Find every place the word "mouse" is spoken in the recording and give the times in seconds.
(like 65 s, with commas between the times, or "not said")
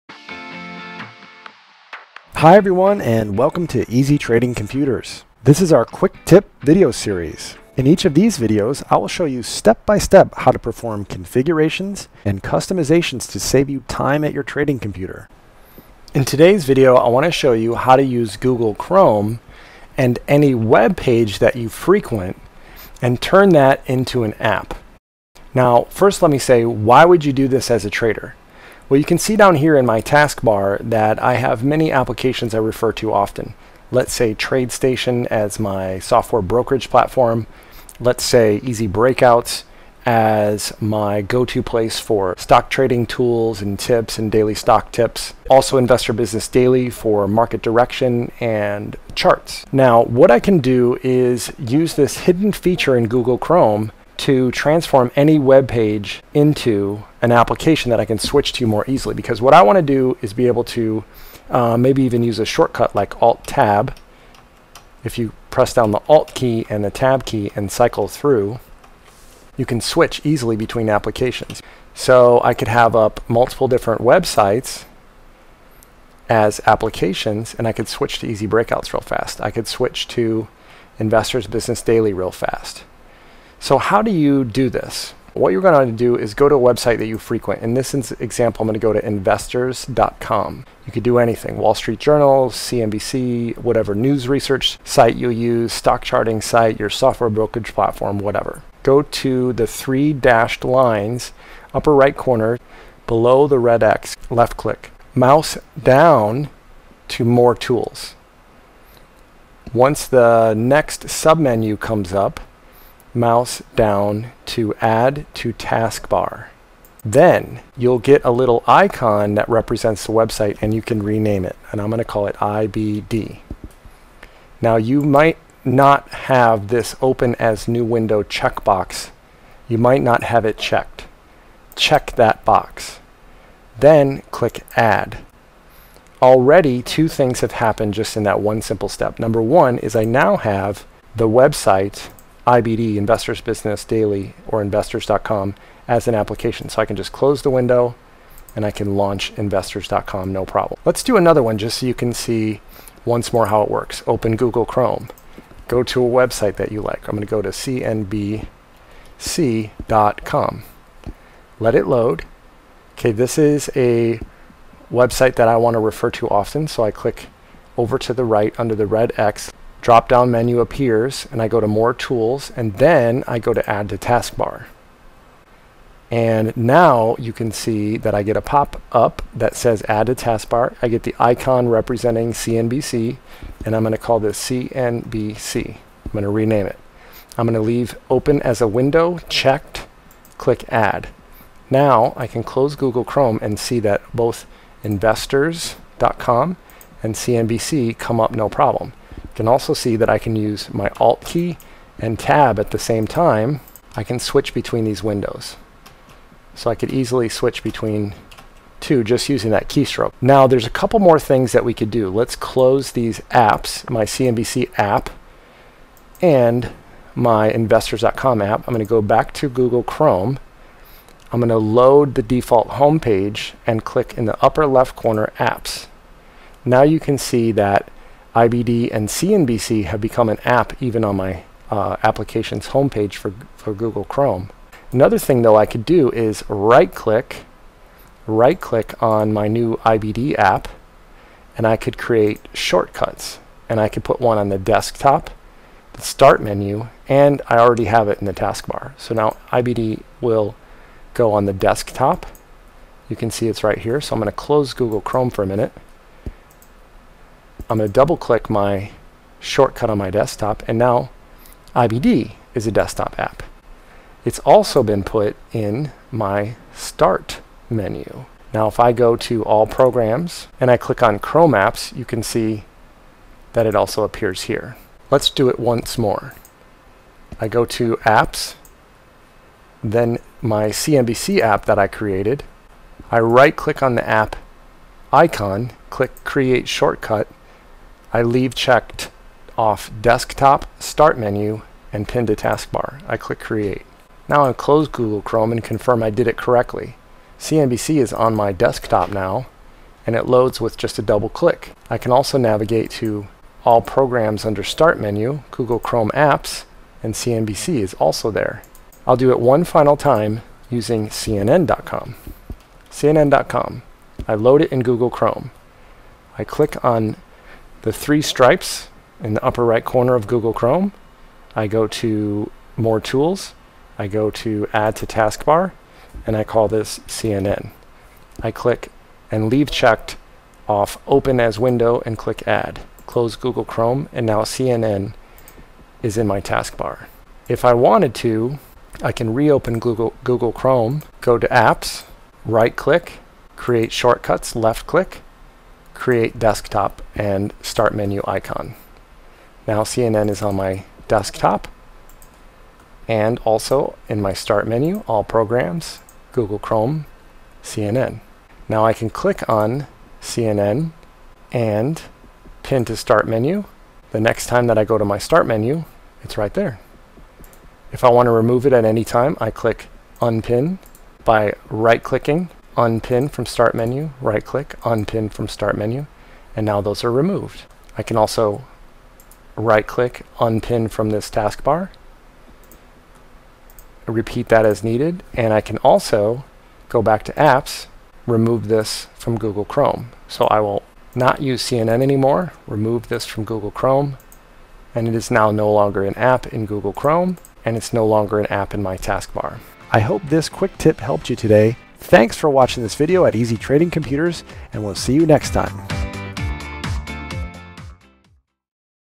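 105 s, 113 s.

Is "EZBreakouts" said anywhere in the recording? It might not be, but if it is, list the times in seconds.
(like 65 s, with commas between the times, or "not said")
38 s, 78 s.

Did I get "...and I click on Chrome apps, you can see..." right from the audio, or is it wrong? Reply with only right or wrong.
right.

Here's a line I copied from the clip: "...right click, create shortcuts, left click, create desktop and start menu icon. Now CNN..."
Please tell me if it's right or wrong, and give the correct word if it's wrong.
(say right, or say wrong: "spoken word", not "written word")
right.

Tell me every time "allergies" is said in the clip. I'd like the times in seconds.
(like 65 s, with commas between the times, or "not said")
not said.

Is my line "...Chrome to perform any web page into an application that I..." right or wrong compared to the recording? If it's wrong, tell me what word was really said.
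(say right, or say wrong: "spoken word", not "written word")
wrong: "transform", not "perform".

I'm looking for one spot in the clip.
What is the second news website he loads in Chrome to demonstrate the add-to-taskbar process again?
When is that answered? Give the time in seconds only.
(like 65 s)
157 s.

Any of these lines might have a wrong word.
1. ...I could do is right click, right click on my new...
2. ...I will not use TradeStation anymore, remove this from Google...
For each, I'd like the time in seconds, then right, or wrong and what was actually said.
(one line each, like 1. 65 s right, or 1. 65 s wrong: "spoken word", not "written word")
1. 235 s right
2. 390 s wrong: "CNN", not "TradeStation".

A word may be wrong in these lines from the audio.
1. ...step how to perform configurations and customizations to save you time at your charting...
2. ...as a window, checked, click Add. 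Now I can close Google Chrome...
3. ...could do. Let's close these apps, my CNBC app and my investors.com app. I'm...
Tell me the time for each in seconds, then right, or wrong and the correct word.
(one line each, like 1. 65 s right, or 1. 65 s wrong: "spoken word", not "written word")
1. 9 s wrong: "trading", not "charting"
2. 188 s right
3. 211 s right.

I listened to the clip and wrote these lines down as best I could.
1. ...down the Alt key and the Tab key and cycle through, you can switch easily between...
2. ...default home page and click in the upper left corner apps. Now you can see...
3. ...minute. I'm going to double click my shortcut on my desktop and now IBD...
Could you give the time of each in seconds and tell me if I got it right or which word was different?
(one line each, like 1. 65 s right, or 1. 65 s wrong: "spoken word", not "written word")
1. 65 s right
2. 222 s right
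3. 255 s right.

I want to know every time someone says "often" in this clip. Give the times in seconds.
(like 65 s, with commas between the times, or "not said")
33 s, 166 s.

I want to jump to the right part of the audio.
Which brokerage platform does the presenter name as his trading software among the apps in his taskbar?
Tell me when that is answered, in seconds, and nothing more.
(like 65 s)
34 s.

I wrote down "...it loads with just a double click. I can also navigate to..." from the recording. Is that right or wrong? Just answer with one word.
right.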